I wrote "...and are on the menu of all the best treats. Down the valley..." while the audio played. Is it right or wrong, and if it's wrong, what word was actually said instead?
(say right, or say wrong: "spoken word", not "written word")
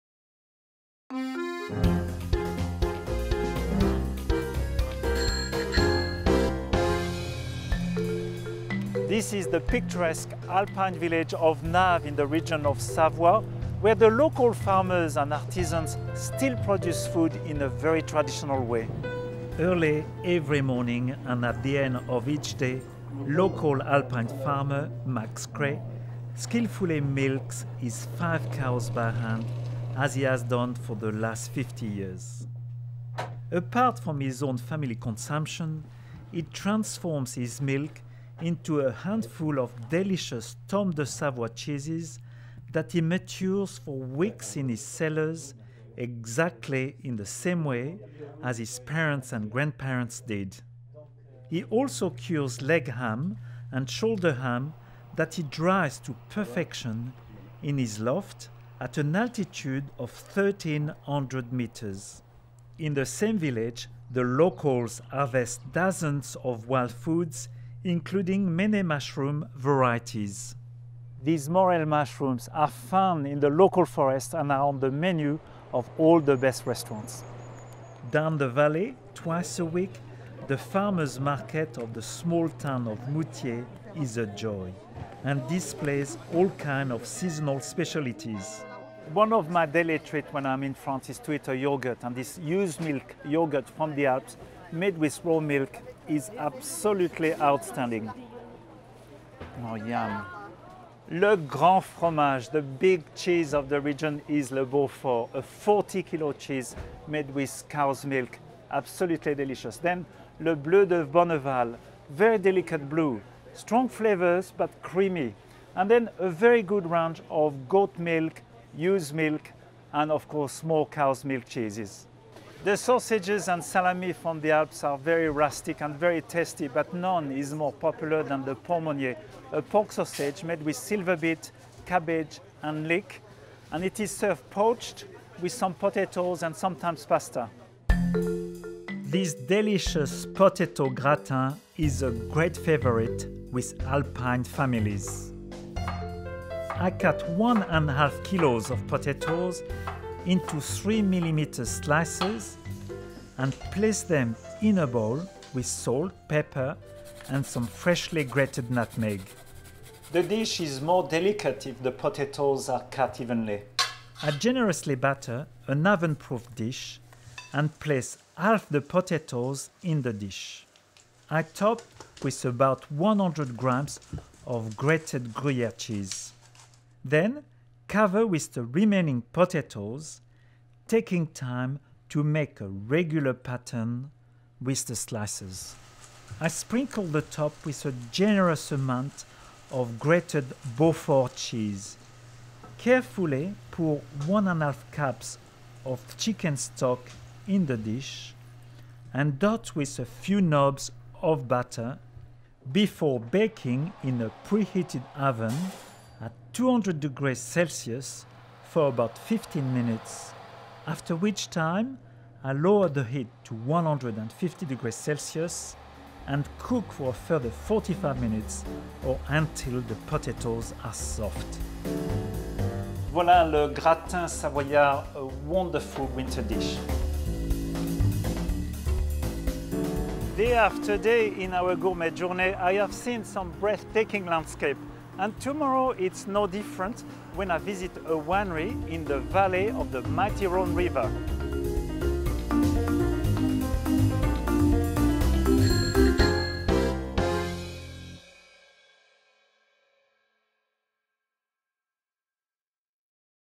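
wrong: "restaurants", not "treats".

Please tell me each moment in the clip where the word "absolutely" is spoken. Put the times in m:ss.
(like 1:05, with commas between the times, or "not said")
1:36, 1:48.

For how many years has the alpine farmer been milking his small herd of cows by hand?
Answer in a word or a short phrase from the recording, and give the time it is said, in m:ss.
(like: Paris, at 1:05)
50 years, at 0:31.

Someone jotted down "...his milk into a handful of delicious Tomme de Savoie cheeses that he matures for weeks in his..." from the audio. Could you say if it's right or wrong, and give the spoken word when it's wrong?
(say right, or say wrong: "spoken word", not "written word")
right.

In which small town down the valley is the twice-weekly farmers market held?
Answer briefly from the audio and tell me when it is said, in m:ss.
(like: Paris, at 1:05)
Moutiers, at 1:23.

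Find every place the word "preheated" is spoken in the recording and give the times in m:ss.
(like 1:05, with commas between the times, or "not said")
3:24.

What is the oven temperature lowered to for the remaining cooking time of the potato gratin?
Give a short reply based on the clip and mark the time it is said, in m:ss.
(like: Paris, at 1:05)
150 degrees Celsius, at 3:33.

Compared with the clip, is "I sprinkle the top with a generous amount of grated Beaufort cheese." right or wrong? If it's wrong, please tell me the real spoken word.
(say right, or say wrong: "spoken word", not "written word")
right.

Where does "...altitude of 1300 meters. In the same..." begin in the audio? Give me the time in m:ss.
0:59.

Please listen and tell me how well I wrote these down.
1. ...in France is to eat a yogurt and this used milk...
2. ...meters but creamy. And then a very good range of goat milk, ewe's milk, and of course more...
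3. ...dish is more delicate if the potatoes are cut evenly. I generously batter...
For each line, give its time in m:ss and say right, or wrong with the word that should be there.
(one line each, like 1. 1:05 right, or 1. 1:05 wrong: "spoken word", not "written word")
1. 1:30 right
2. 1:53 wrong: "flavors", not "meters"
3. 2:40 right.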